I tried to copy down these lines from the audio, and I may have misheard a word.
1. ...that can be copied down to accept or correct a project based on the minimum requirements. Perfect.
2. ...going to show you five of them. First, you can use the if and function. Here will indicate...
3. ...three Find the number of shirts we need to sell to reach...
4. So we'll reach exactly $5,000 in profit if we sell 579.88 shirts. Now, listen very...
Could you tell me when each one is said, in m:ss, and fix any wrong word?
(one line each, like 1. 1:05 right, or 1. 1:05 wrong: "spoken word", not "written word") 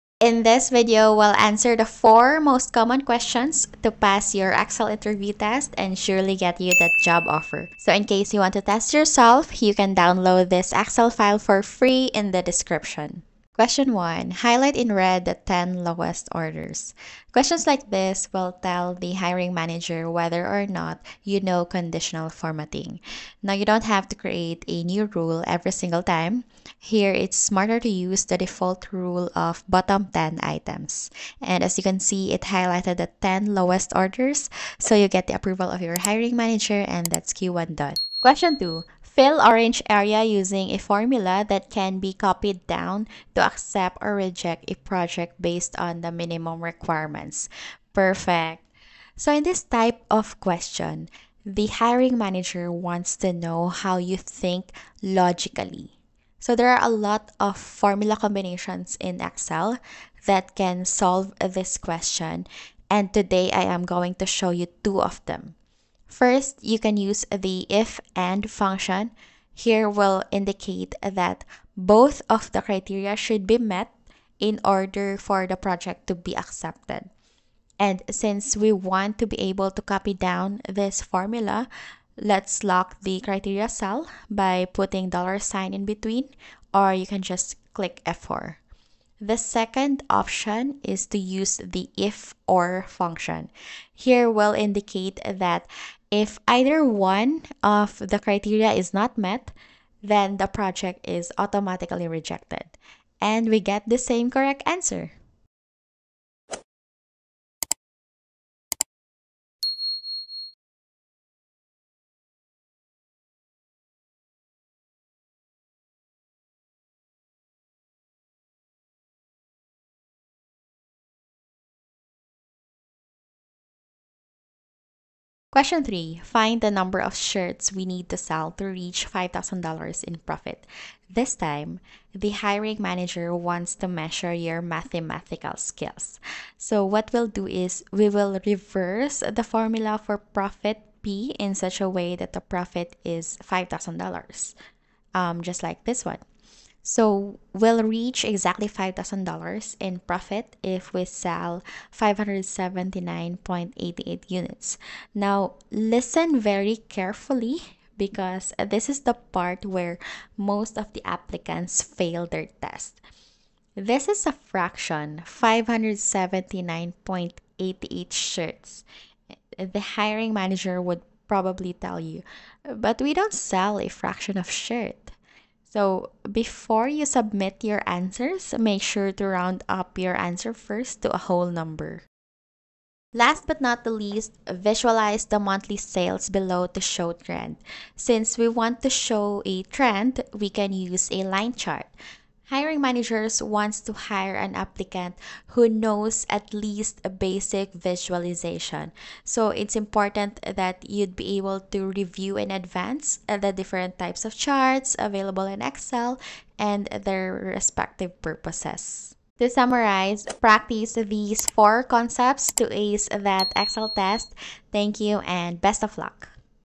1. 0:41 wrong: "reject", not "correct"
2. 1:03 wrong: "two", not "five"
3. 2:05 right
4. 2:26 wrong: "units", not "shirts".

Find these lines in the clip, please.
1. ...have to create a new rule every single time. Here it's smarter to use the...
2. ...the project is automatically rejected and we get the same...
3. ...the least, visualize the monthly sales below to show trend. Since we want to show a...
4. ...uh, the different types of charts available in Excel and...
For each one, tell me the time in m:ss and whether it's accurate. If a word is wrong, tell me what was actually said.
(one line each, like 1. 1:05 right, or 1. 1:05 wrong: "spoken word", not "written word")
1. 0:23 right
2. 1:40 right
3. 3:03 right
4. 3:23 right.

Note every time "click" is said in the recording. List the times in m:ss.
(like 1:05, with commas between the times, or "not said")
1:27.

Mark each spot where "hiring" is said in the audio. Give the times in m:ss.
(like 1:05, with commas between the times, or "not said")
0:19, 0:36, 0:51, 2:12, 2:49, 3:12.